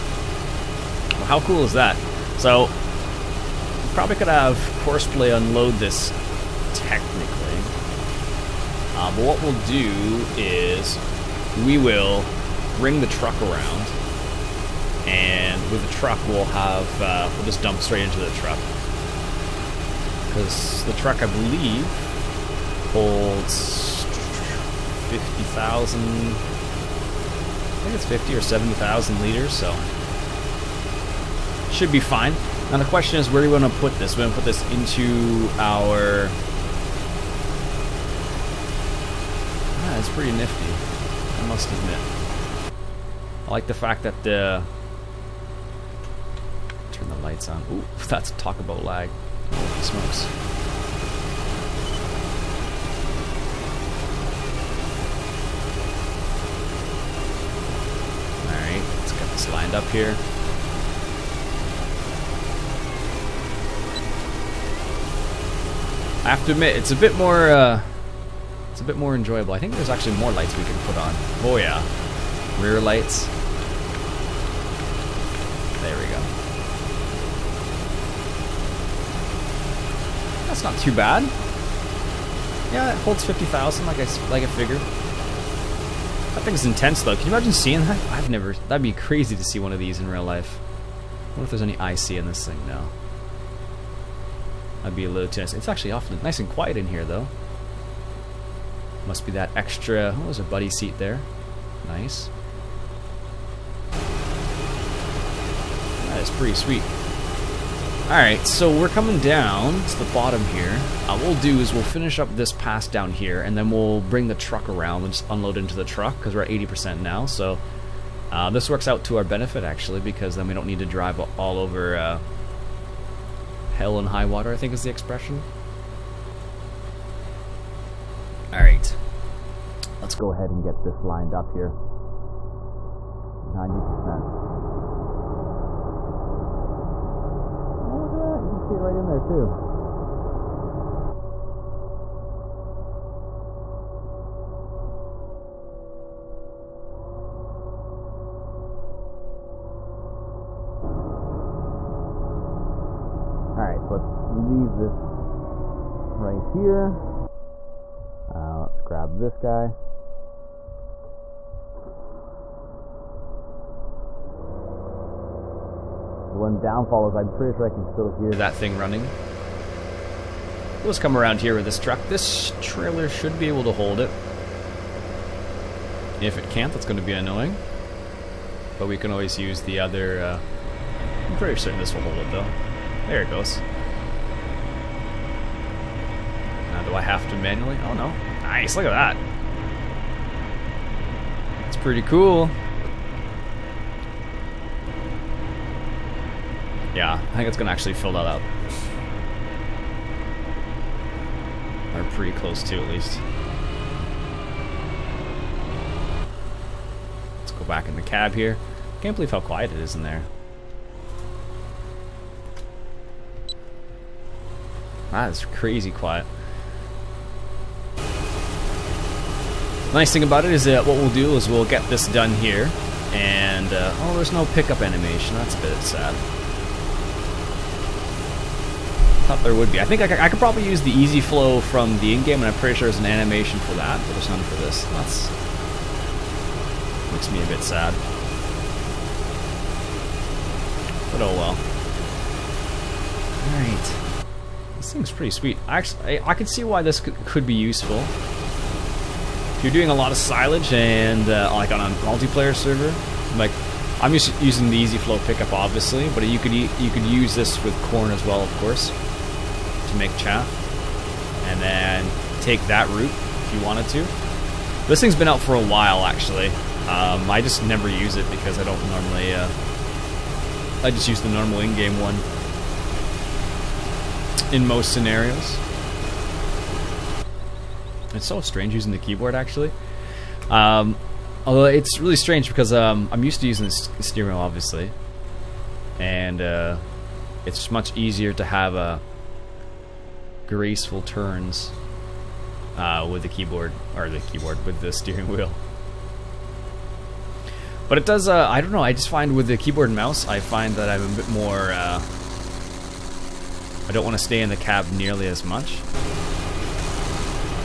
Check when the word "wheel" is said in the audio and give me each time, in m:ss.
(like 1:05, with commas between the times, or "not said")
4:44, 4:55.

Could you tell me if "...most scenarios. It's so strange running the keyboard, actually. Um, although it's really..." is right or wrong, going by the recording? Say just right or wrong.
wrong.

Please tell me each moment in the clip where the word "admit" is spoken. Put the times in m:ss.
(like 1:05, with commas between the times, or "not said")
0:41, 1:06.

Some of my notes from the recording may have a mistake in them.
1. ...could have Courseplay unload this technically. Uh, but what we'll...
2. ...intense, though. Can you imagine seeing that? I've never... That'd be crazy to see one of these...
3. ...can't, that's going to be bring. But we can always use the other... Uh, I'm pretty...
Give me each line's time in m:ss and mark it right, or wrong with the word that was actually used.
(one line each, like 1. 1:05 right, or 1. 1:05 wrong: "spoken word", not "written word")
1. 0:04 right
2. 1:26 right
3. 2:56 wrong: "annoying", not "bring".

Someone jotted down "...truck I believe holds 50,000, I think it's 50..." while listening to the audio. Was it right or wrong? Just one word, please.
right.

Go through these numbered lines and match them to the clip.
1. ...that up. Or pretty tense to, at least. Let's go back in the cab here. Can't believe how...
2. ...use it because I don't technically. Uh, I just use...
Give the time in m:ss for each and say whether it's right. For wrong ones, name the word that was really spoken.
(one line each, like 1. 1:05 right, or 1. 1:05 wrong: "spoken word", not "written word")
1. 3:18 wrong: "close", not "tense"
2. 4:27 wrong: "normally", not "technically".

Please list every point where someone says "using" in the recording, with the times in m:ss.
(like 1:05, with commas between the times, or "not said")
4:14, 4:38, 4:43.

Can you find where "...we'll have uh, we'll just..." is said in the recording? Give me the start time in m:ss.
0:16.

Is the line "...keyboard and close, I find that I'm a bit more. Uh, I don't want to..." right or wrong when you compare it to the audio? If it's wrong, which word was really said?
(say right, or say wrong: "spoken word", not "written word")
wrong: "mouse", not "close".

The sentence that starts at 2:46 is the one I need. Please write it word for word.
The one downfall is I'm pretty sure I can still hear that thing running.